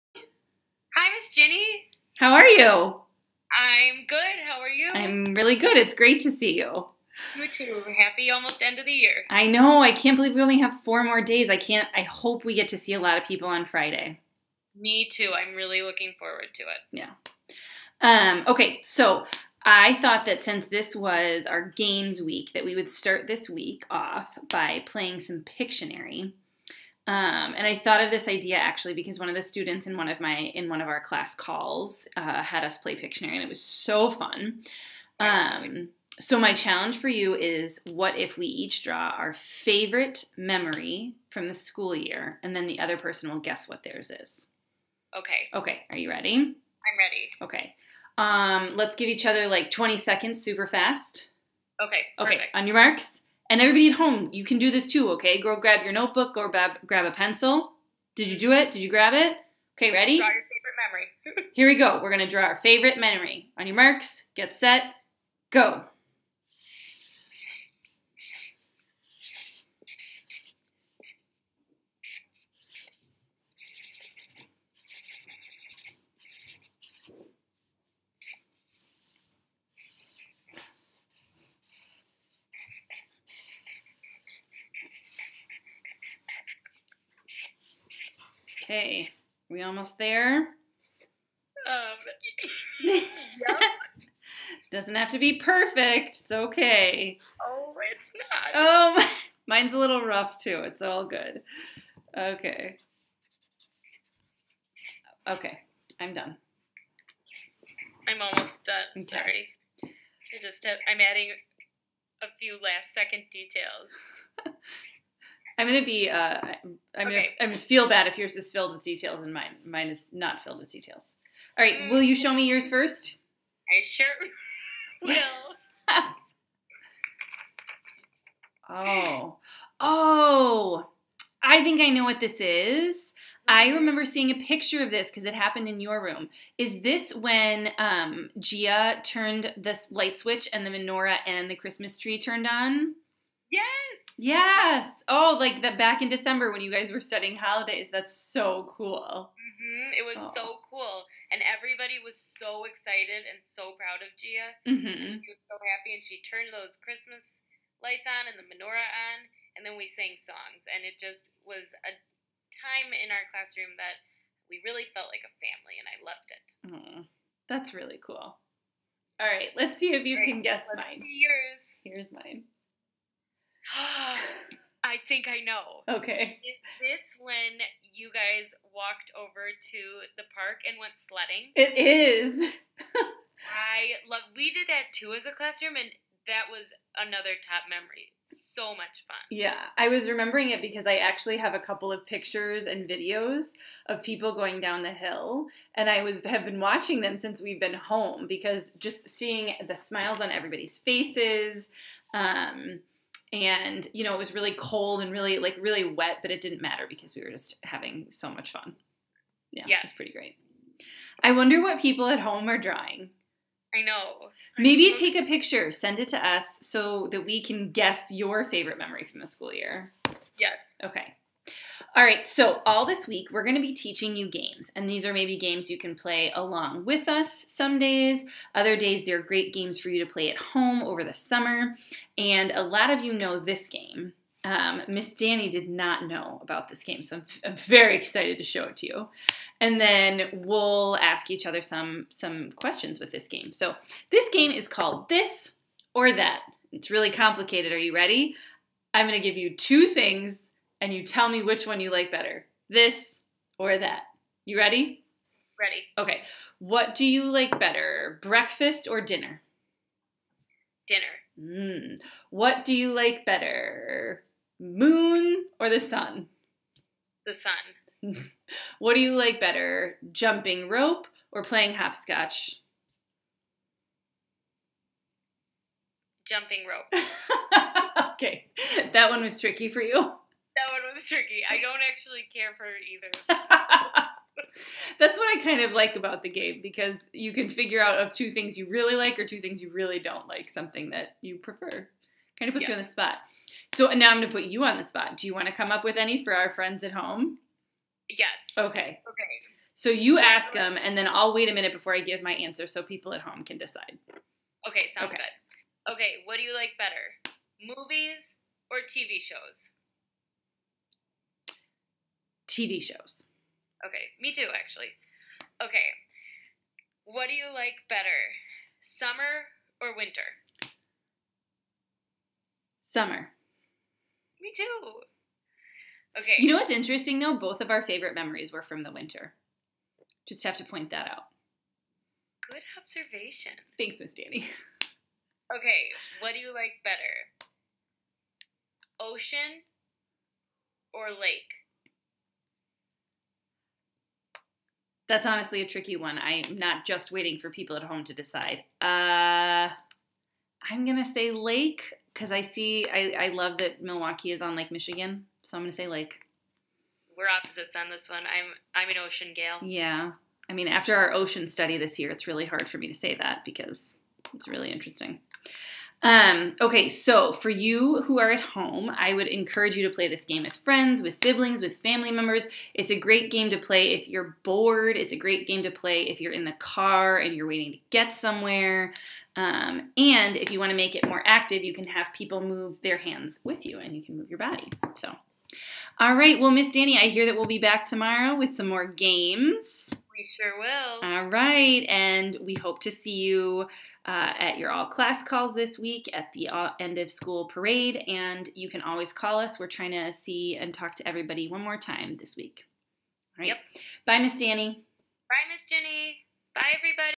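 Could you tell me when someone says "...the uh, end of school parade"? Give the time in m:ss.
6:36.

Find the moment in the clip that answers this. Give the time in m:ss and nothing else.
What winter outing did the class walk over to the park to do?
3:00.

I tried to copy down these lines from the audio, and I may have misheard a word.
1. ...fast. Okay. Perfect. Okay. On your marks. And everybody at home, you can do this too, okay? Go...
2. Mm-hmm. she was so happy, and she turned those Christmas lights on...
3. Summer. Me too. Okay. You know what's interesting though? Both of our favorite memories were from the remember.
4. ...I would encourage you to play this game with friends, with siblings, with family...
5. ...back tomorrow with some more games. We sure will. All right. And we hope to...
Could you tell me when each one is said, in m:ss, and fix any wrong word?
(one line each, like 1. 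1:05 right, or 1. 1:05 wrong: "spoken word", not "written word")
1. 0:50 right
2. 2:34 right
3. 5:22 wrong: "winter", not "remember"
4. 6:08 right
5. 6:27 right.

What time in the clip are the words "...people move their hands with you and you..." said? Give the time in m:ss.
6:22.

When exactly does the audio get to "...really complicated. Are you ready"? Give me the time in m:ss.
4:06.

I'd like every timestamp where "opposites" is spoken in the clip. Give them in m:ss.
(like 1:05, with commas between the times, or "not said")
5:57.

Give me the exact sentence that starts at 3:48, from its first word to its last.
Other days, they're great games for you to play at home over the summer.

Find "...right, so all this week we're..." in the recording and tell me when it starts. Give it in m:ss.
3:42.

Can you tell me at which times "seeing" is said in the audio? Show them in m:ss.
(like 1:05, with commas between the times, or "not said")
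2:14, 3:19.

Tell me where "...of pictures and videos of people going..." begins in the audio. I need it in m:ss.
3:11.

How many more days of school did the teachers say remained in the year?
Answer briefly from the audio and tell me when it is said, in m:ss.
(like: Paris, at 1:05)
4, at 0:10.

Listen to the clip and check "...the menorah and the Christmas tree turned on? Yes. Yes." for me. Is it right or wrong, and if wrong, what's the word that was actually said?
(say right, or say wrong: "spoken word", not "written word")
right.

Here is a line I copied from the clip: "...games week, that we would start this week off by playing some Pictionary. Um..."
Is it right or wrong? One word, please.
right.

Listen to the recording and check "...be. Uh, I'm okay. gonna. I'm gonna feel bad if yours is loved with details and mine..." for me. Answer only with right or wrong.
wrong.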